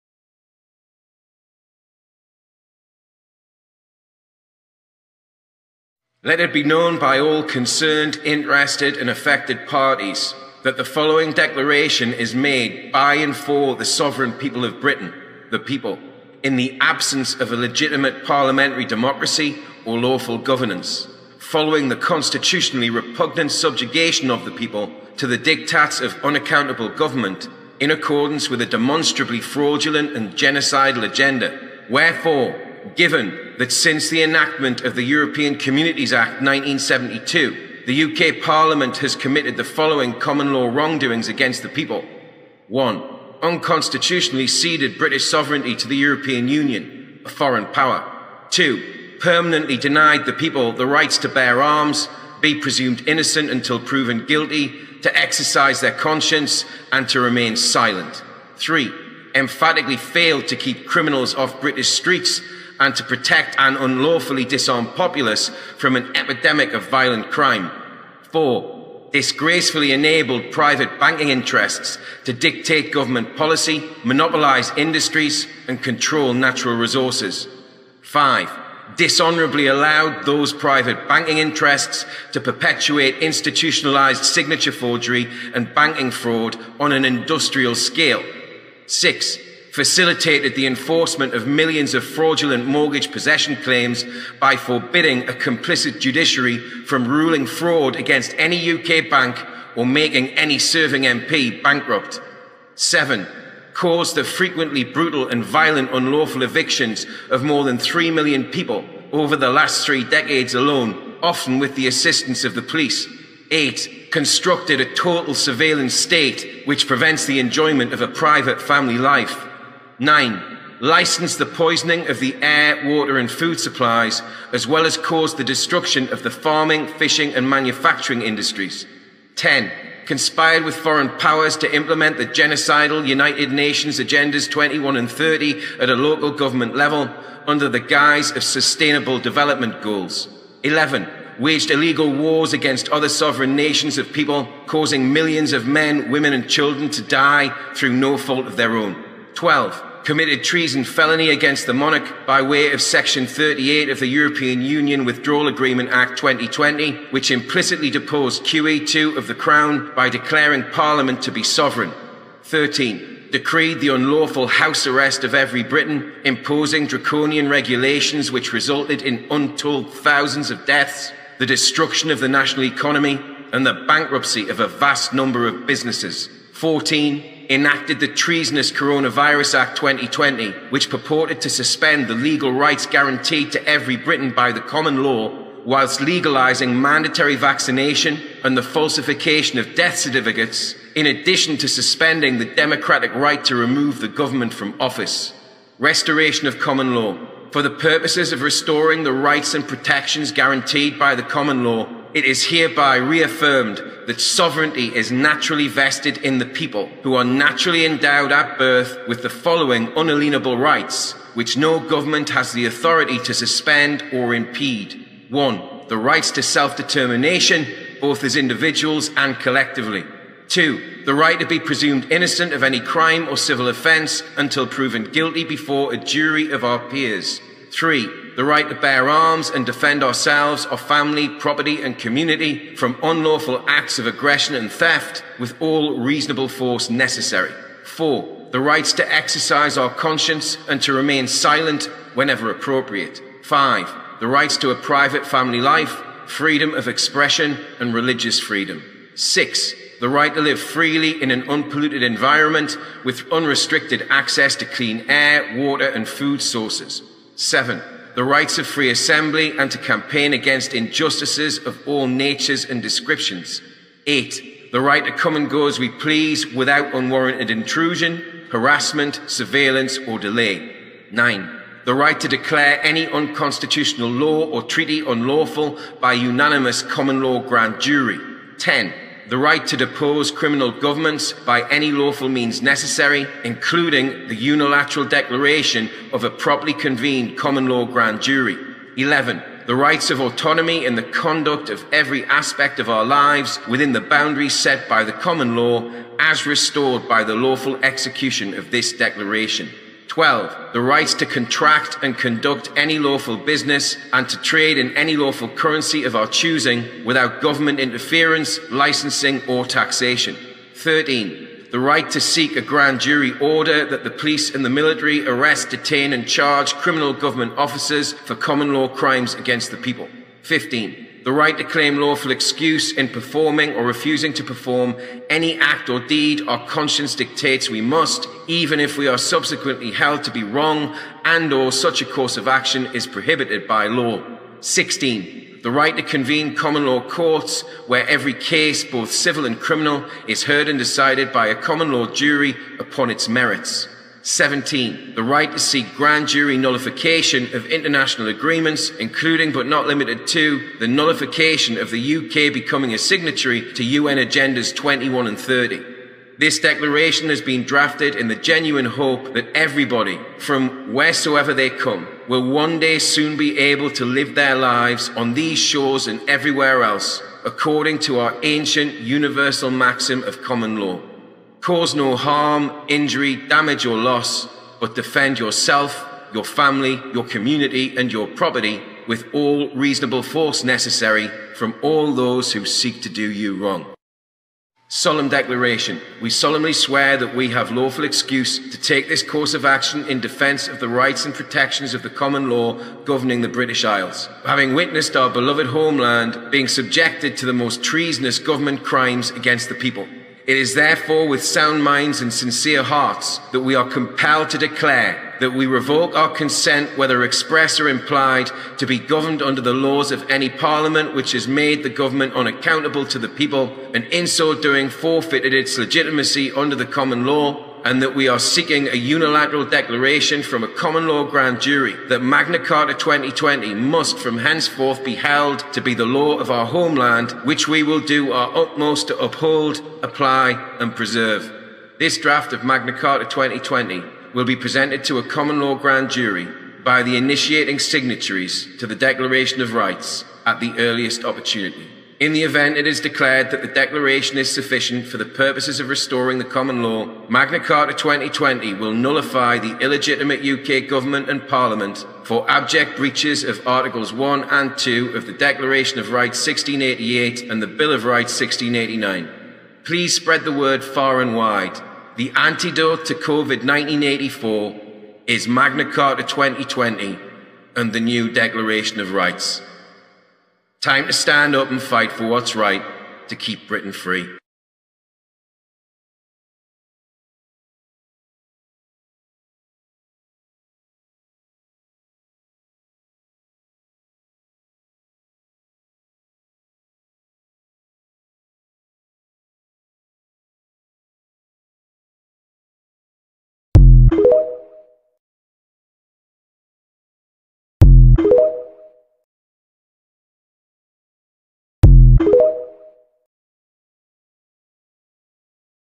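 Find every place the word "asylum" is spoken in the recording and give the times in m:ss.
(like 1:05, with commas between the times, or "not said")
not said.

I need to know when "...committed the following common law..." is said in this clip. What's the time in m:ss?
0:39.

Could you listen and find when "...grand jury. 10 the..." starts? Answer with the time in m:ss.
4:37.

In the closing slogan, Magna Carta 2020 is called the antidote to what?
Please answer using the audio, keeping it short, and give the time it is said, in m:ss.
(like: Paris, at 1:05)
COVID 1984, at 7:43.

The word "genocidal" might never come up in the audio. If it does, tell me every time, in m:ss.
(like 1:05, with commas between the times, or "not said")
0:30, 2:12.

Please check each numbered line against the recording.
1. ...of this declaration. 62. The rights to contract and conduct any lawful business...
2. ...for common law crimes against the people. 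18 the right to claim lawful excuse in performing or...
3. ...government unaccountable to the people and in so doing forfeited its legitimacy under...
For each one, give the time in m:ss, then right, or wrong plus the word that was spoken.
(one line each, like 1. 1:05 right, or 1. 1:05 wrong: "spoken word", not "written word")
1. 4:58 wrong: "12", not "62"
2. 5:18 wrong: "15", not "18"
3. 6:51 right.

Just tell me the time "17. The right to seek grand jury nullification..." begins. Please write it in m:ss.
5:44.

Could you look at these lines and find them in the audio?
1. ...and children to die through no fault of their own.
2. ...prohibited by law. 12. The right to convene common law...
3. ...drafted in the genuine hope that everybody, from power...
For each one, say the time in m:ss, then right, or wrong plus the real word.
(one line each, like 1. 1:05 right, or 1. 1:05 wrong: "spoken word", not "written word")
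1. 2:26 right
2. 5:33 wrong: "16", not "12"
3. 5:57 wrong: "wheresoever", not "power".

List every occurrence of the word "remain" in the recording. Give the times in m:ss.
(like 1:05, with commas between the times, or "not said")
0:57, 4:00.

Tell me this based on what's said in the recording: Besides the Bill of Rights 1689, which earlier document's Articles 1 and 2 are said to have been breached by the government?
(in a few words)
Declaration of Rights 1688.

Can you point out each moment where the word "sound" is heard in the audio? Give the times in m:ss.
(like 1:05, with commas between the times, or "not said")
6:41.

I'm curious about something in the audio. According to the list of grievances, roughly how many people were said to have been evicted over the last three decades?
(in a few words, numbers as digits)
more than 3 million.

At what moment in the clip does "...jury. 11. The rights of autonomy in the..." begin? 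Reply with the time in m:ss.
4:48.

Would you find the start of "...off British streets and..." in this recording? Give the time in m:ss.
1:01.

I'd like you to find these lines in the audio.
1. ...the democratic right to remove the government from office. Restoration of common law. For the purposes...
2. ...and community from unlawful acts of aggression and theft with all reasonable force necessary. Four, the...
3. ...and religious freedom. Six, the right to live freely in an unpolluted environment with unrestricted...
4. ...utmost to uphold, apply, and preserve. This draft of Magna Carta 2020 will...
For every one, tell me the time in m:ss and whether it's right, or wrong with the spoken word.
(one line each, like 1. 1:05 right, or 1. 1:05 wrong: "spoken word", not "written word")
1. 3:12 right
2. 3:51 right
3. 4:07 right
4. 7:08 right.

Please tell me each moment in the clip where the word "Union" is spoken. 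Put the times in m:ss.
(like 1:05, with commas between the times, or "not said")
0:46, 2:34.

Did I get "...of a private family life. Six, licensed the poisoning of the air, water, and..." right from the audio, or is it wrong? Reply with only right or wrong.
wrong.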